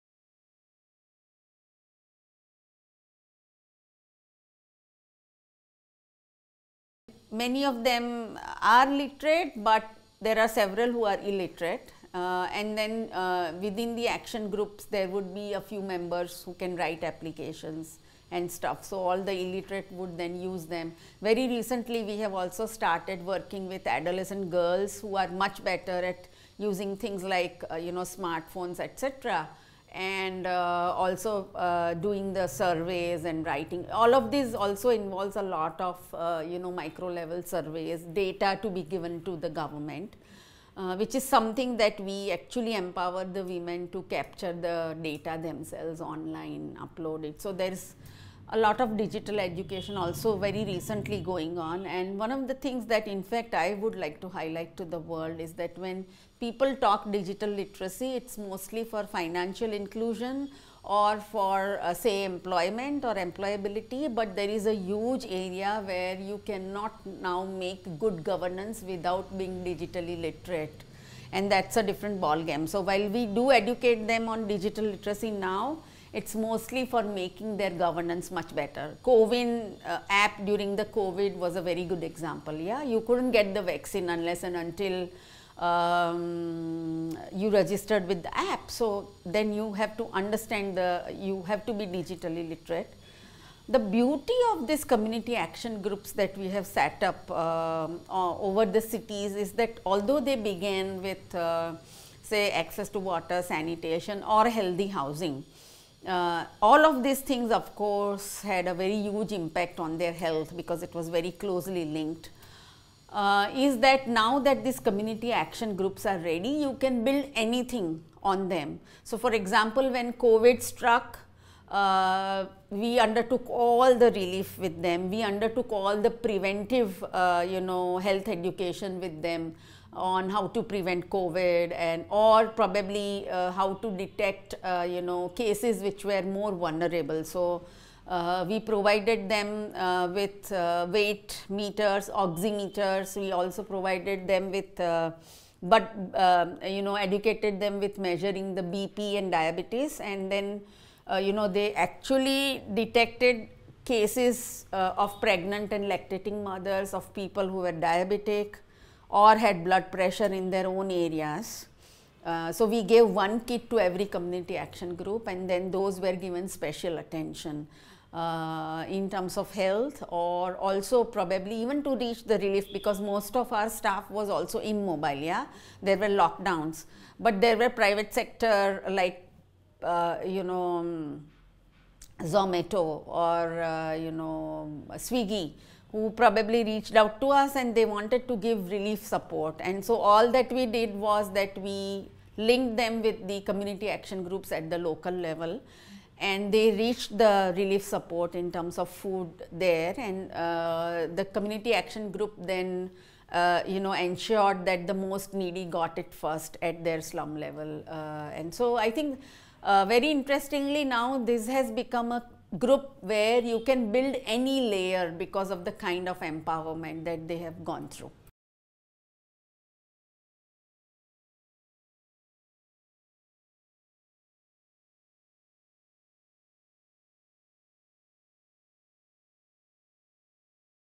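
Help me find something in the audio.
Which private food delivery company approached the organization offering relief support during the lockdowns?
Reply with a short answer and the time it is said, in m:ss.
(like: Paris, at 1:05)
Zomato, at 3:02.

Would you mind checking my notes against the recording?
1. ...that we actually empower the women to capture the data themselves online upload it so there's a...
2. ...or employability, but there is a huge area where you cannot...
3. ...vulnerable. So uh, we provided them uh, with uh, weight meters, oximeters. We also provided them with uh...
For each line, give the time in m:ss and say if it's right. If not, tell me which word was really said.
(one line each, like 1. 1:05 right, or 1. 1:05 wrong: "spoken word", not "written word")
1. 0:41 right
2. 1:03 right
3. 2:16 right.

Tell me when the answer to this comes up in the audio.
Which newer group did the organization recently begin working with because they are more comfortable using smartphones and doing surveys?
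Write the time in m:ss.
0:23.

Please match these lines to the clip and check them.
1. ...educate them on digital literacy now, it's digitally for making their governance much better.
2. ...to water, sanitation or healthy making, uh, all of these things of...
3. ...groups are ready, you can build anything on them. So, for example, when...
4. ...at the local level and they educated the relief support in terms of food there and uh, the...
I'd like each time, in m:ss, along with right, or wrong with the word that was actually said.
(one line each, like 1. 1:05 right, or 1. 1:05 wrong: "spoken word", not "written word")
1. 1:13 wrong: "mostly", not "digitally"
2. 1:42 wrong: "housing", not "making"
3. 1:55 right
4. 3:14 wrong: "reached", not "educated".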